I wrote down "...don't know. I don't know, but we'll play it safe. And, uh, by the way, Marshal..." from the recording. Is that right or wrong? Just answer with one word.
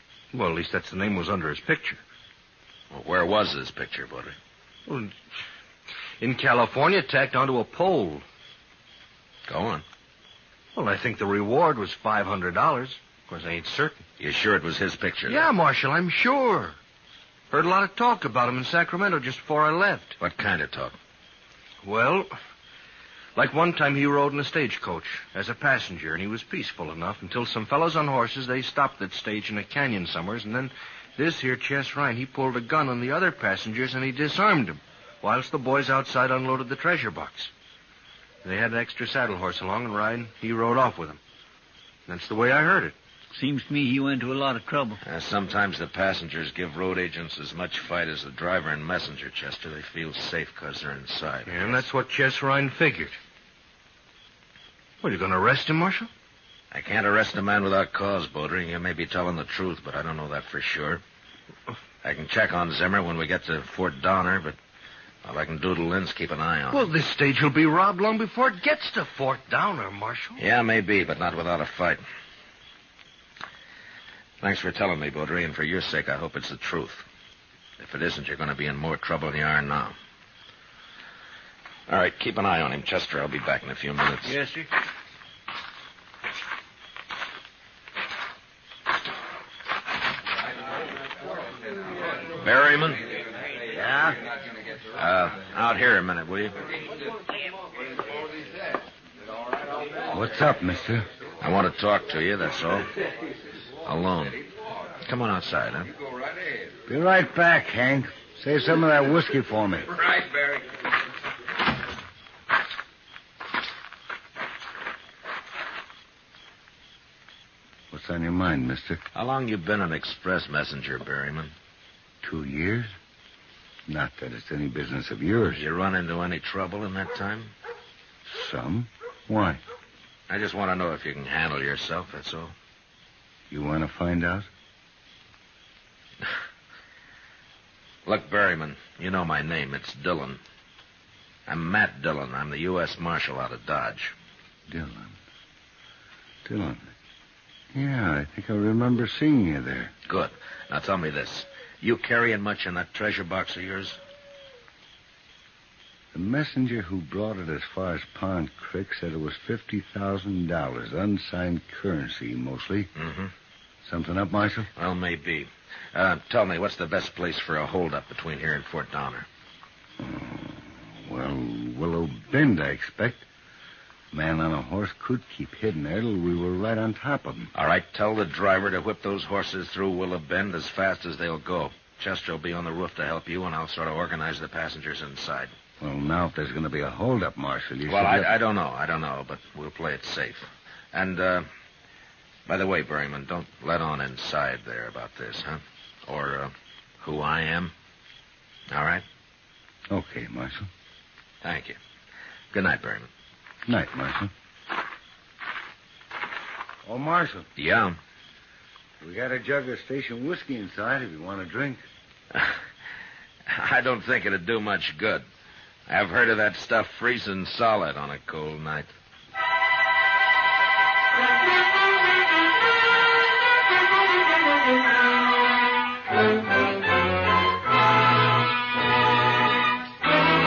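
wrong.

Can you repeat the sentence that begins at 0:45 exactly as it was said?
Uh, sometimes the passengers give road agents as much fight as the driver and messenger, Chester.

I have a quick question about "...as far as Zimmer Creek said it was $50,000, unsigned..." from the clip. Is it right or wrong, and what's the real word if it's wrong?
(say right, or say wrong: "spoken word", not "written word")
wrong: "Pond", not "Zimmer".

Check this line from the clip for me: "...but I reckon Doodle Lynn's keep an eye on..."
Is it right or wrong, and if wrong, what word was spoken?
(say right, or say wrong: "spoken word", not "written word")
right.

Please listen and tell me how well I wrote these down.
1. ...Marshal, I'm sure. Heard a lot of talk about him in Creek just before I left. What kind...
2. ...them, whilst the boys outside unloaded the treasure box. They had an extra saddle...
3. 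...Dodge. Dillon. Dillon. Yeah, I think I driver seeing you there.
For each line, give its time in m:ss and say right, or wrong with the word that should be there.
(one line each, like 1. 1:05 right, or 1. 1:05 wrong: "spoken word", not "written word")
1. 0:15 wrong: "Sacramento", not "Creek"
2. 0:34 right
3. 2:23 wrong: "remember", not "driver".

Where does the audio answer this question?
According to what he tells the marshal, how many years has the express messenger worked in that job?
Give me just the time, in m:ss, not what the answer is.
2:02.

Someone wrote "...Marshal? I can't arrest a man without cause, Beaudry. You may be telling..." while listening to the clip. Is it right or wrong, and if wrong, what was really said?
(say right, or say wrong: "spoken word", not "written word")
right.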